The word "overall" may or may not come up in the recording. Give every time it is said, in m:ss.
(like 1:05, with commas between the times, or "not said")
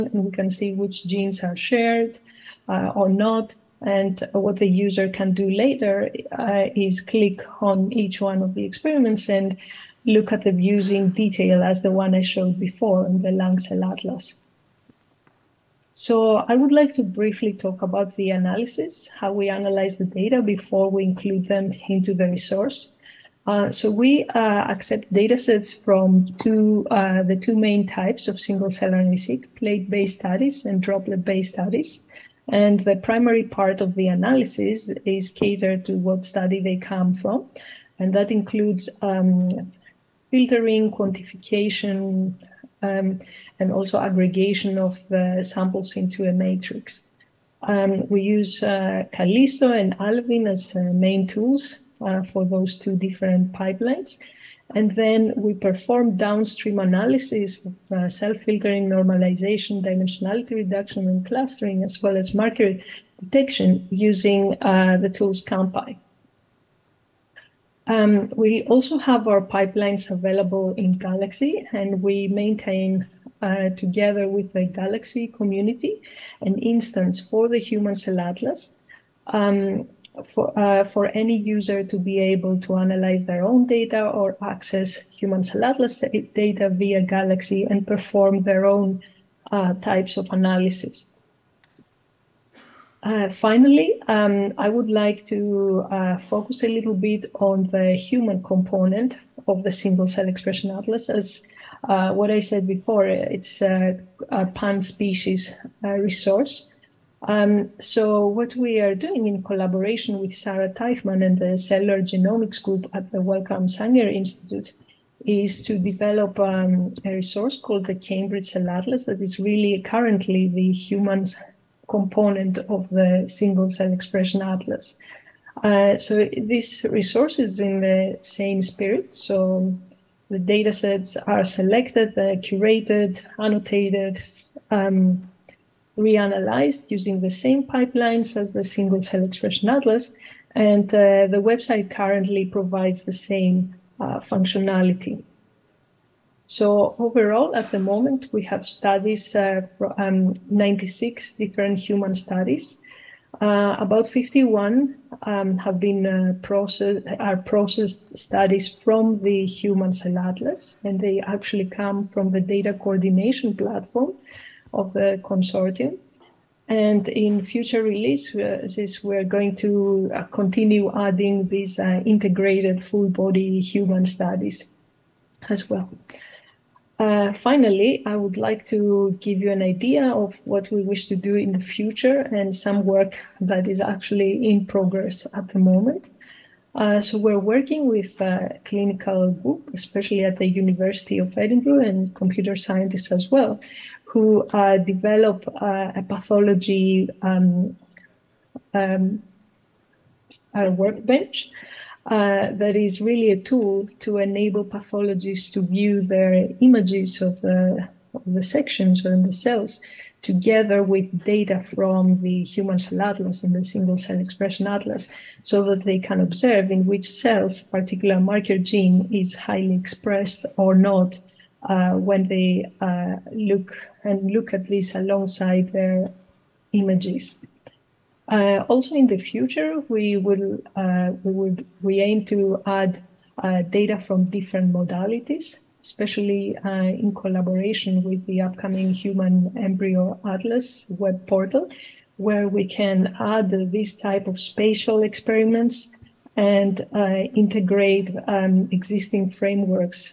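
2:26.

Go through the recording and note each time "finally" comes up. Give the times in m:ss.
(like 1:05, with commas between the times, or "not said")
1:33, 2:57.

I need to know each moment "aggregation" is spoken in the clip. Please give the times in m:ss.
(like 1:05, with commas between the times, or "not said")
0:43.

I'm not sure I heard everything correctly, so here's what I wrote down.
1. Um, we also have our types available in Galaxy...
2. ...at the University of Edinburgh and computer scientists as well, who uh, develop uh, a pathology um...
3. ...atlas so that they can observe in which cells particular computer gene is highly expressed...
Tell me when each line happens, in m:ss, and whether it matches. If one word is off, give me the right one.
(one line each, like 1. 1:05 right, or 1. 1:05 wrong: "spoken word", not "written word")
1. 1:07 wrong: "pipelines", not "types"
2. 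3:10 right
3. 3:34 wrong: "marker", not "computer".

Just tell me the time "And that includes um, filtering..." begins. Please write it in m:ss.
0:37.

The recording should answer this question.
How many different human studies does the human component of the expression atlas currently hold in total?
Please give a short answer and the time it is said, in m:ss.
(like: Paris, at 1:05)
96, at 2:30.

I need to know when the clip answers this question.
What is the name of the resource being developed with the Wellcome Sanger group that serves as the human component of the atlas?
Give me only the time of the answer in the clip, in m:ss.
1:57.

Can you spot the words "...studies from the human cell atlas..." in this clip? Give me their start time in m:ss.
2:38.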